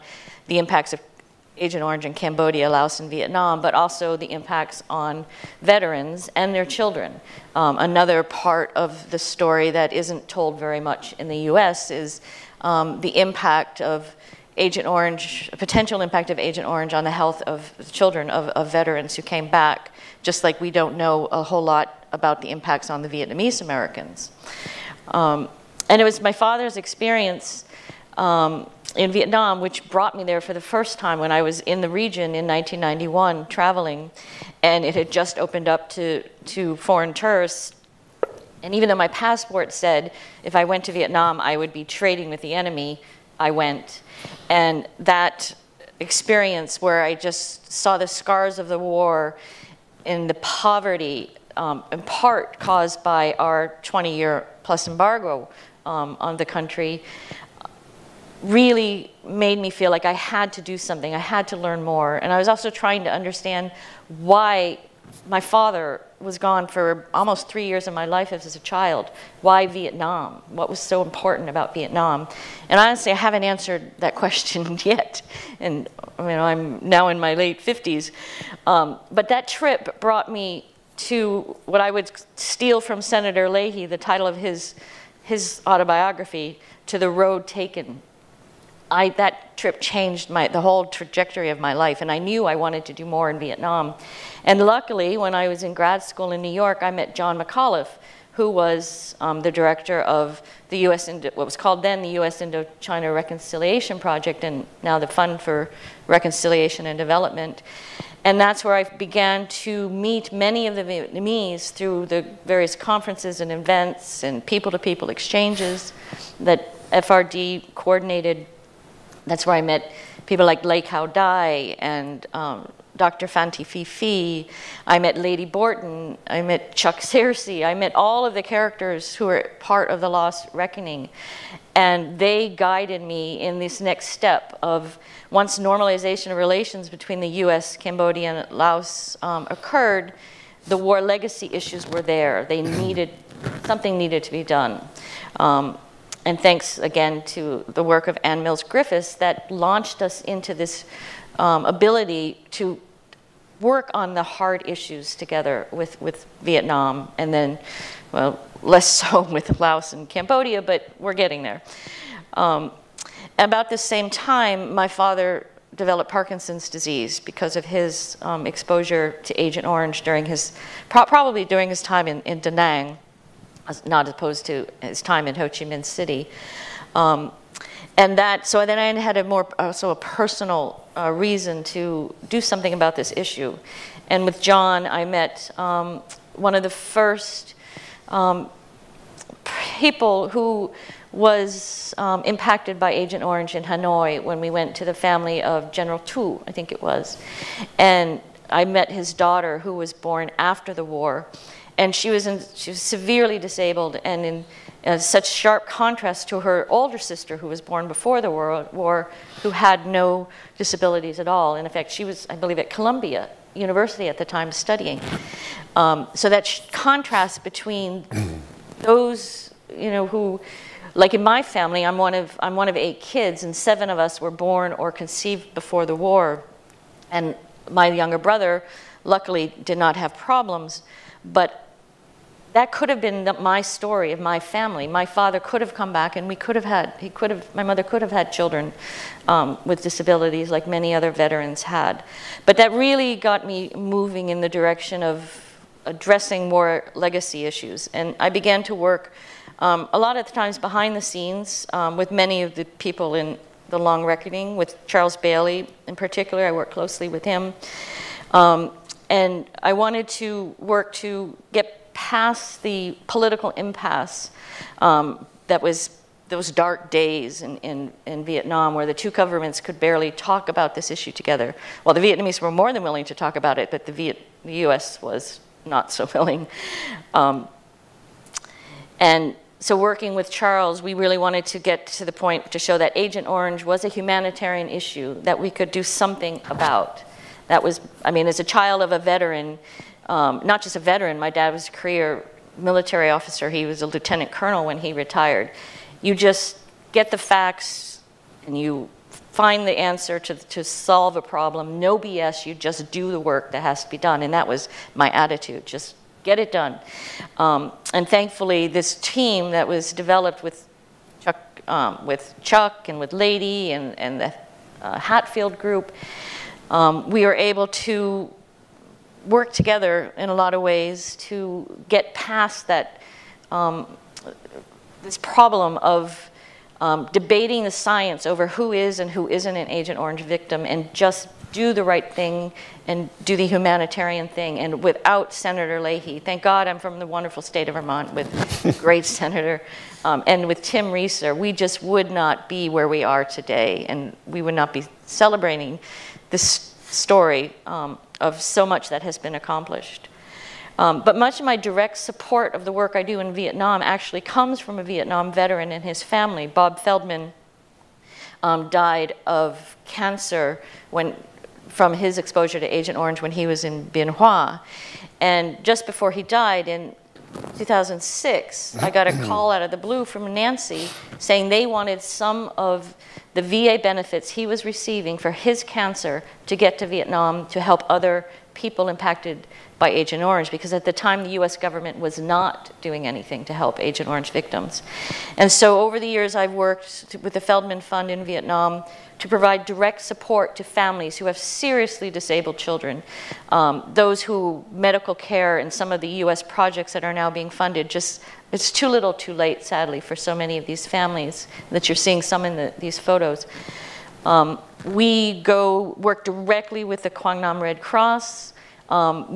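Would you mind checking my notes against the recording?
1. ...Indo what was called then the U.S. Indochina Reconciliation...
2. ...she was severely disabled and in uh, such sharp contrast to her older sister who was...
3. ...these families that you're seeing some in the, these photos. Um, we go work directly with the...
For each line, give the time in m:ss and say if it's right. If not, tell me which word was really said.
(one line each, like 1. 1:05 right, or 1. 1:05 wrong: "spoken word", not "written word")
1. 1:41 right
2. 3:22 right
3. 6:40 right.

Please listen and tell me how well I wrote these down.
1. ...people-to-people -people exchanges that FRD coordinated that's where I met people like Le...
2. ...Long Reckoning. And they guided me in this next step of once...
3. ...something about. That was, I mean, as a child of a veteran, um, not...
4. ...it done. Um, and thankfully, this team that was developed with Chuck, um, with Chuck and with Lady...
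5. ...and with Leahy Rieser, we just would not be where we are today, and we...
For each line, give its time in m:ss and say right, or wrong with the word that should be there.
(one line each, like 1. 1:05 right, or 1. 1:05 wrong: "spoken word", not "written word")
1. 1:54 right
2. 2:10 right
3. 4:45 right
4. 5:06 right
5. 5:40 wrong: "Tim", not "Leahy".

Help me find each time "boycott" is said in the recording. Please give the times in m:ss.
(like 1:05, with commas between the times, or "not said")
not said.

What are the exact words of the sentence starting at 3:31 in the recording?
And in fact, she was, I believe, at Columbia University at the time studying.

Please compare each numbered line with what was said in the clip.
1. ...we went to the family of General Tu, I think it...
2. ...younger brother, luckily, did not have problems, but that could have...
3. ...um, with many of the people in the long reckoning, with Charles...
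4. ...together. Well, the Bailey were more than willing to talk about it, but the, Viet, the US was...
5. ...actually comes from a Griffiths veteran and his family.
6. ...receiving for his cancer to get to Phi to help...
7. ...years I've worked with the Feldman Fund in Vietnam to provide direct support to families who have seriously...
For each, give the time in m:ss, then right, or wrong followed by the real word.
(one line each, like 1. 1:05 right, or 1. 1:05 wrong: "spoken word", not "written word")
1. 3:14 right
2. 3:47 right
3. 4:11 right
4. 4:31 wrong: "Vietnamese", not "Bailey"
5. 5:53 wrong: "Vietnam", not "Griffiths"
6. 6:14 wrong: "Vietnam", not "Phi"
7. 6:26 right.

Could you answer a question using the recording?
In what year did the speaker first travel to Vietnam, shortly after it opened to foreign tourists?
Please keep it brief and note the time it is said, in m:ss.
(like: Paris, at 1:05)
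1991, at 0:32.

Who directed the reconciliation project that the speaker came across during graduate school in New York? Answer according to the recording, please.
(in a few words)
John McAuliffe.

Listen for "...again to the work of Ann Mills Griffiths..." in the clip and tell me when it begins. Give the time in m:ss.
2:26.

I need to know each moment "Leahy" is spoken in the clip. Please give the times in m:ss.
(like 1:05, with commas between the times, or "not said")
1:23, 5:35.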